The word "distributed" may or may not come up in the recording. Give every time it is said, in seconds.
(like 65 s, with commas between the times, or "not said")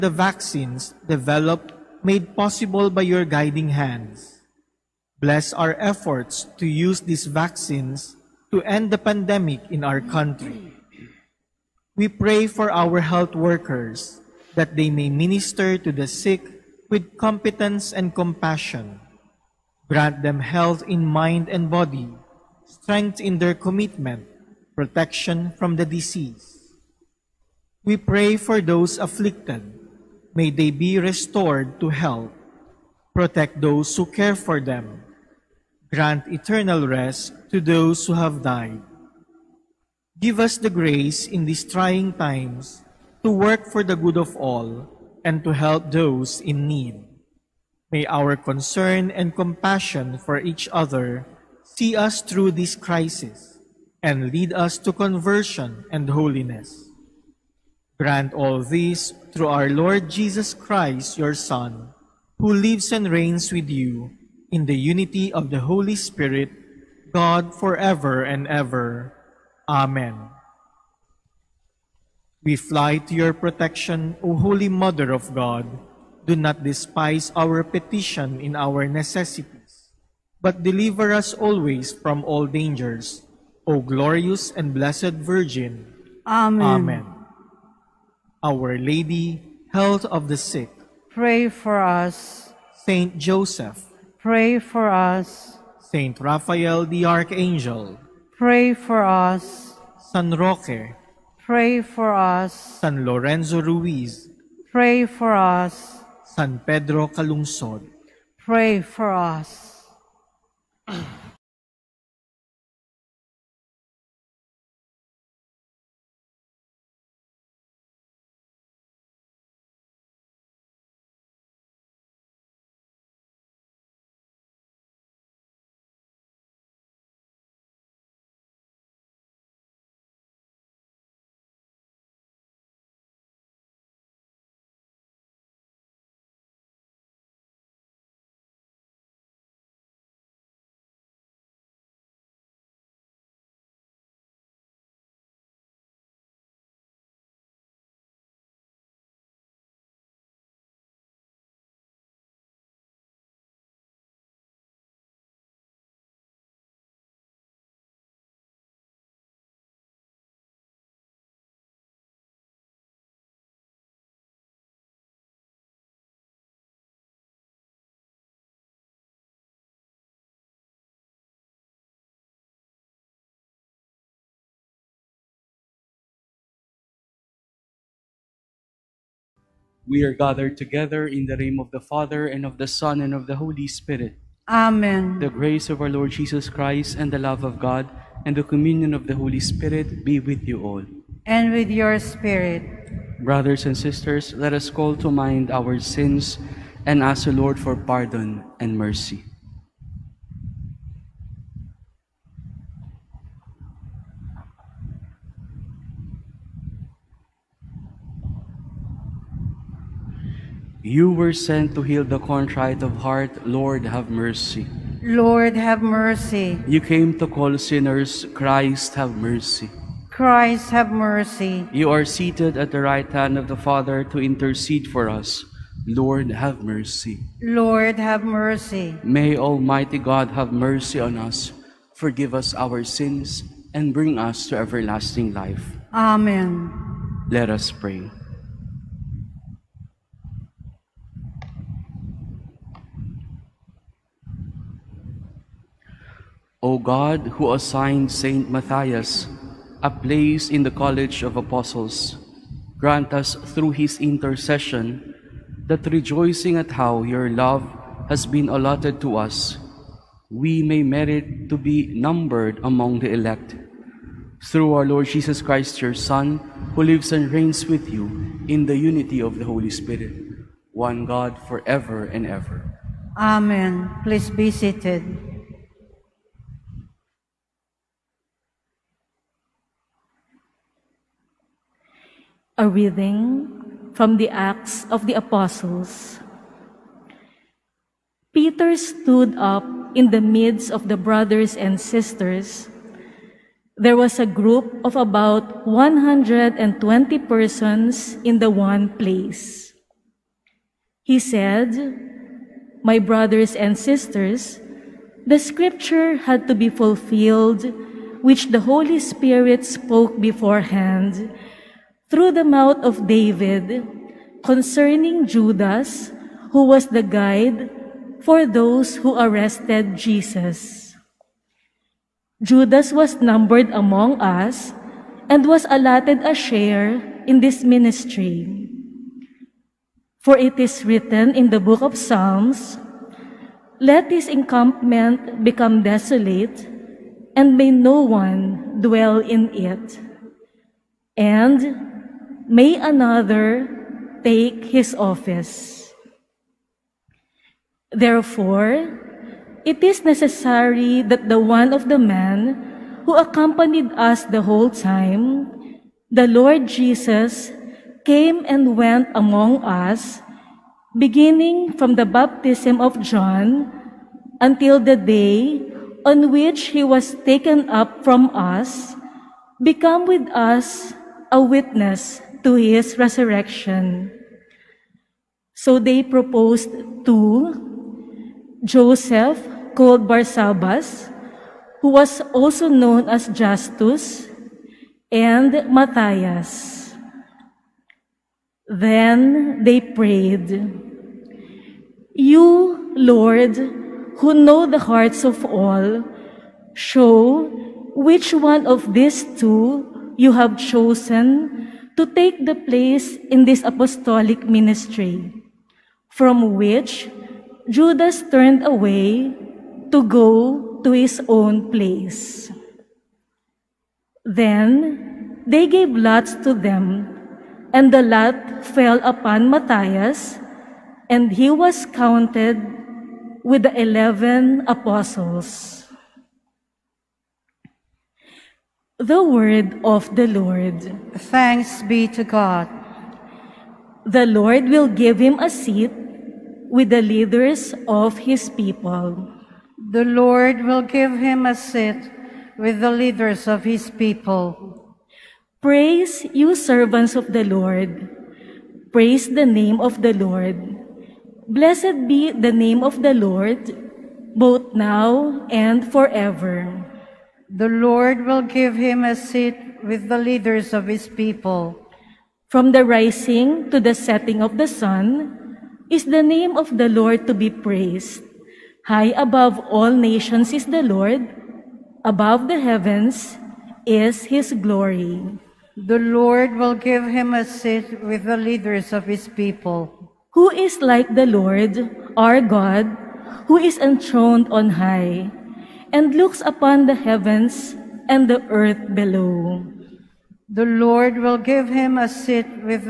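not said.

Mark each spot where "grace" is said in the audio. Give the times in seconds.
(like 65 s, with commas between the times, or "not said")
40 s, 185 s.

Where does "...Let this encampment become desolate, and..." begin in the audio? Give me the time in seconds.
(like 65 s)
333 s.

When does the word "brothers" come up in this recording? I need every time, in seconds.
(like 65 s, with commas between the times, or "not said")
193 s, 290 s, 302 s.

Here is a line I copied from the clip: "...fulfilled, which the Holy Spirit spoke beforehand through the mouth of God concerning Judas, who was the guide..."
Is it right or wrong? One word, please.
wrong.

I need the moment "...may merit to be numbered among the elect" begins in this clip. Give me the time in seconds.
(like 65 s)
260 s.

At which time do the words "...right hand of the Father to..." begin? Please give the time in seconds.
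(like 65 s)
222 s.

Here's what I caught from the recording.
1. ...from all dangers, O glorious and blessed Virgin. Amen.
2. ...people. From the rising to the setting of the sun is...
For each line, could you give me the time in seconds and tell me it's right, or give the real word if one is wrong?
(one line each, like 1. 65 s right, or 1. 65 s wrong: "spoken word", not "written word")
1. 81 s right
2. 461 s right.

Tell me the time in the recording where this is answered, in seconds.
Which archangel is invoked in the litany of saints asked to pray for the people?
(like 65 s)
95 s.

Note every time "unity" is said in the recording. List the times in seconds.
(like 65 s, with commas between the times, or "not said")
64 s, 268 s.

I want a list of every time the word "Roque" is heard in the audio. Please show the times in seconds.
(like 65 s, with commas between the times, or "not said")
100 s.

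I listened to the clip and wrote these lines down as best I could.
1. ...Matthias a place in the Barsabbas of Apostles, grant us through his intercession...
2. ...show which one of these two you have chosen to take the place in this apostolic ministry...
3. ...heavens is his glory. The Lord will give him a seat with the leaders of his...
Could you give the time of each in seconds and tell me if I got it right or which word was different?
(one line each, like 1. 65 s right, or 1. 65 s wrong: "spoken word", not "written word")
1. 248 s wrong: "College", not "Barsabbas"
2. 396 s right
3. 472 s right.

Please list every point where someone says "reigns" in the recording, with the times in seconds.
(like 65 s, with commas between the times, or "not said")
63 s, 267 s.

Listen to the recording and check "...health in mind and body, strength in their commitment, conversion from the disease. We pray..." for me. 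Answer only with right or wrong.
wrong.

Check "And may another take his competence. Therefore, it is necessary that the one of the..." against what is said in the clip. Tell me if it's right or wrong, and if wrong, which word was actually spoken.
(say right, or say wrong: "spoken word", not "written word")
wrong: "office", not "competence".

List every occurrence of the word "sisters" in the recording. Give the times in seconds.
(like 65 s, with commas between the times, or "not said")
193 s, 291 s, 303 s.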